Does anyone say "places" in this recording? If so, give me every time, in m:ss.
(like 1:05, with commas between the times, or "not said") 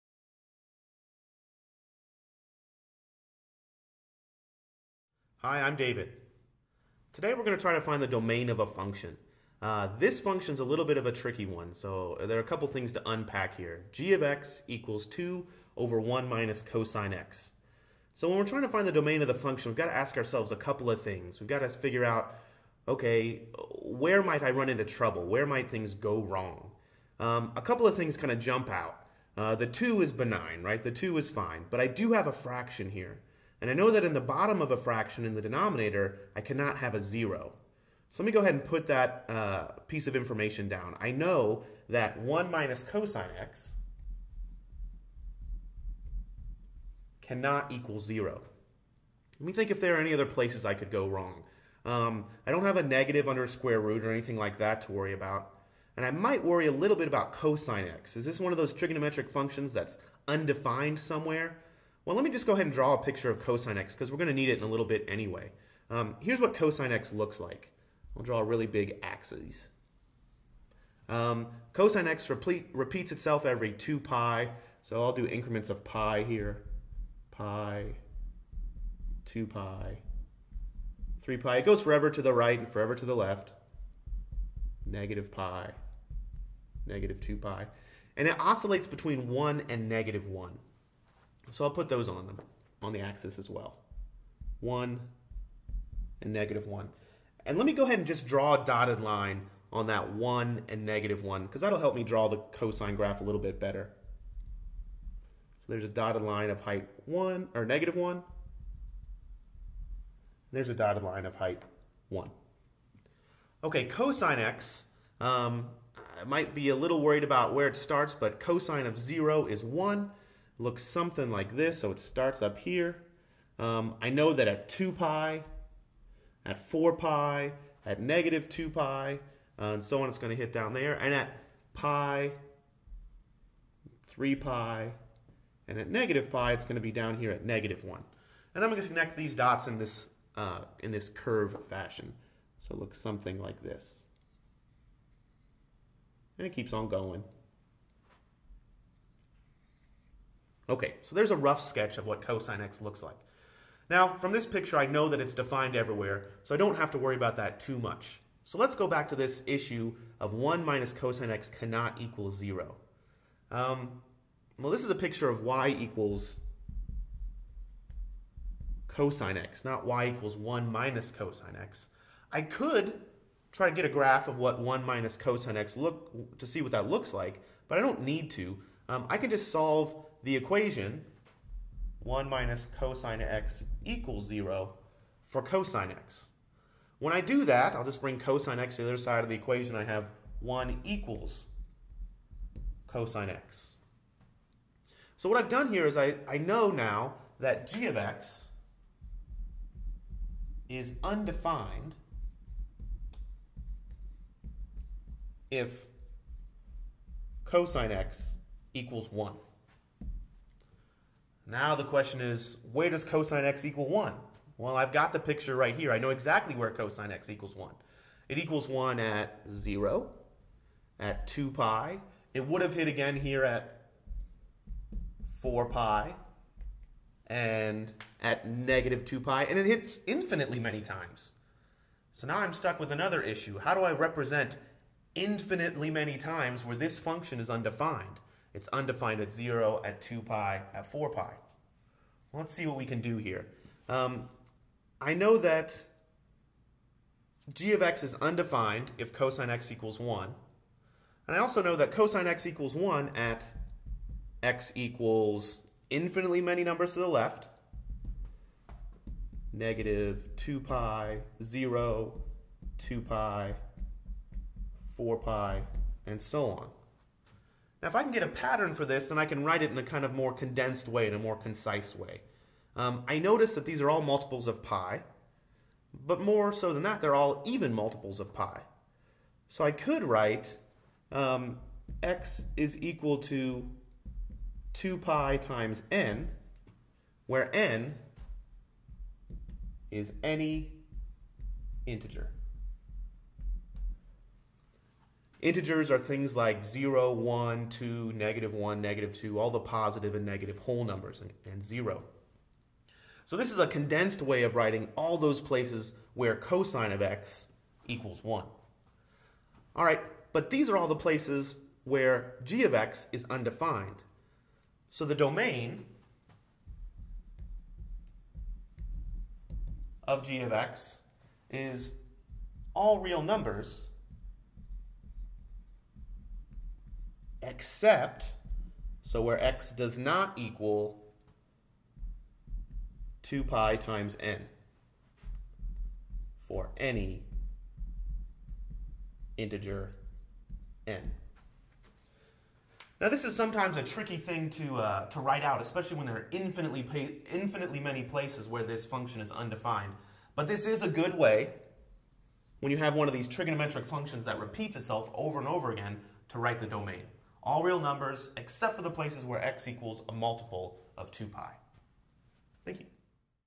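0:50, 5:05, 5:10, 5:48, 5:58.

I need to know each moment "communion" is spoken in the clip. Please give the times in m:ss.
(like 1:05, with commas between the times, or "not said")
not said.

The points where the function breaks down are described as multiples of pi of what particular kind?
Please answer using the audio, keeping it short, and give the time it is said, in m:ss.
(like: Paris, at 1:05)
even, at 4:37.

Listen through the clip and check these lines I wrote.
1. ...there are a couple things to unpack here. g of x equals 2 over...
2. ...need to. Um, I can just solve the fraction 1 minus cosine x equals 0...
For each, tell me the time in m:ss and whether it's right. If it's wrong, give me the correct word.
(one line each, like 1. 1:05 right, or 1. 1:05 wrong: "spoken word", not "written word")
1. 0:12 right
2. 2:58 wrong: "equation", not "fraction".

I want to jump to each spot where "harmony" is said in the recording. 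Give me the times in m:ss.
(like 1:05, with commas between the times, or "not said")
not said.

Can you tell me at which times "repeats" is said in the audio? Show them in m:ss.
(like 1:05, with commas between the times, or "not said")
1:12, 5:54.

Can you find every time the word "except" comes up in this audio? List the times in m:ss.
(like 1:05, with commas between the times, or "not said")
5:27, 5:58.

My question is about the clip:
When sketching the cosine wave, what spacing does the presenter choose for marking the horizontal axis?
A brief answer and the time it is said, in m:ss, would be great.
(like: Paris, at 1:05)
increments of pi, at 1:15.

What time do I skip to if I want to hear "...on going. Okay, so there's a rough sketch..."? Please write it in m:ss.
2:26.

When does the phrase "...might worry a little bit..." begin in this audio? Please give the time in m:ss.
0:56.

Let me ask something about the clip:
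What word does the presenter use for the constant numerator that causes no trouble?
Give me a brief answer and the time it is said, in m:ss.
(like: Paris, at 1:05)
benign, at 0:30.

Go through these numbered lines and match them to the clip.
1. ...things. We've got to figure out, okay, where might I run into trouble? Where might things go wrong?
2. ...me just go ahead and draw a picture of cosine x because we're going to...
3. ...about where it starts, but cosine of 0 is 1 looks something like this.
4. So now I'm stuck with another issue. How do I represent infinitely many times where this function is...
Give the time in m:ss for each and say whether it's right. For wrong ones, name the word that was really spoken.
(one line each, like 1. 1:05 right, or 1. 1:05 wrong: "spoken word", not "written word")
1. 0:21 right
2. 1:02 right
3. 1:57 right
4. 3:52 right.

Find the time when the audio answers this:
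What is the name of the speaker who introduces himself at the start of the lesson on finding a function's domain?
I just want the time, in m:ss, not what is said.
0:05.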